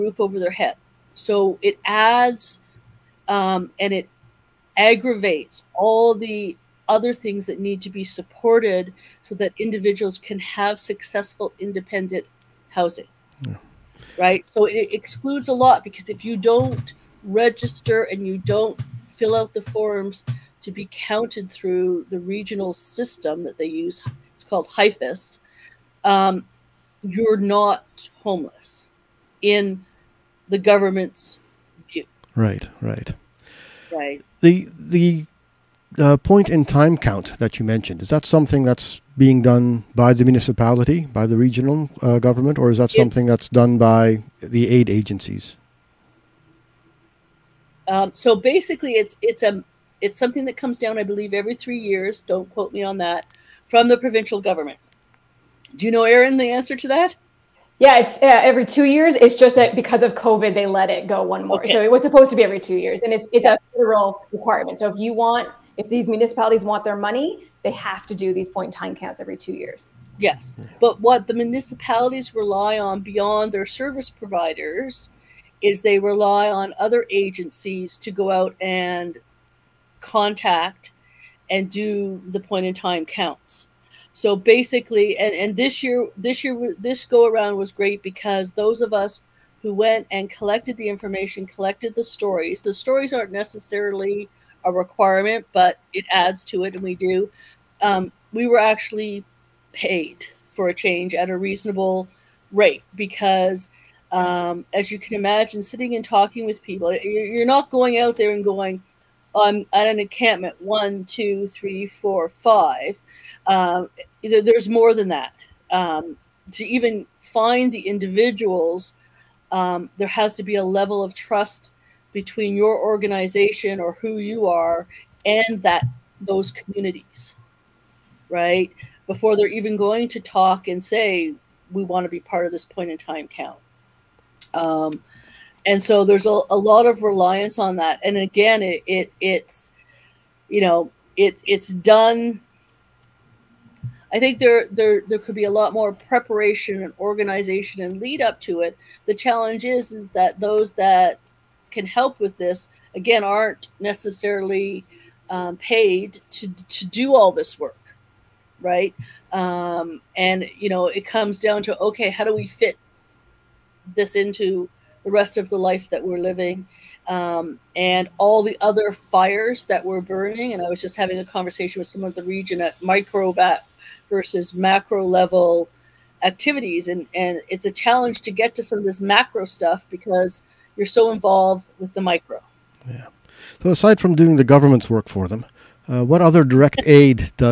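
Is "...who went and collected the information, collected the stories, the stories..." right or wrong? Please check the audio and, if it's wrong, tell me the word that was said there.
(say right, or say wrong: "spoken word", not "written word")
right.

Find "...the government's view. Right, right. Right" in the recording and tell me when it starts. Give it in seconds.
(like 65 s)
30 s.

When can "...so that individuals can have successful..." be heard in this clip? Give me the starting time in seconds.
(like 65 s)
9 s.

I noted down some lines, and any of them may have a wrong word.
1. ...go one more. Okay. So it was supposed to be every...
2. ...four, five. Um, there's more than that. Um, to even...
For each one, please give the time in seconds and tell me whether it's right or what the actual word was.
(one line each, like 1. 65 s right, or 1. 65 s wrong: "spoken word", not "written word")
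1. 61 s right
2. 111 s right.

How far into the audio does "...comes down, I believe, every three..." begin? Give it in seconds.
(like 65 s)
50 s.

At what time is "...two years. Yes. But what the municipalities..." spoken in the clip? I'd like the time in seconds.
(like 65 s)
69 s.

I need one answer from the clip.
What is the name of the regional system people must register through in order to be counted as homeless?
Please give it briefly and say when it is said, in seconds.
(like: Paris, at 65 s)
HIFIS, at 24 s.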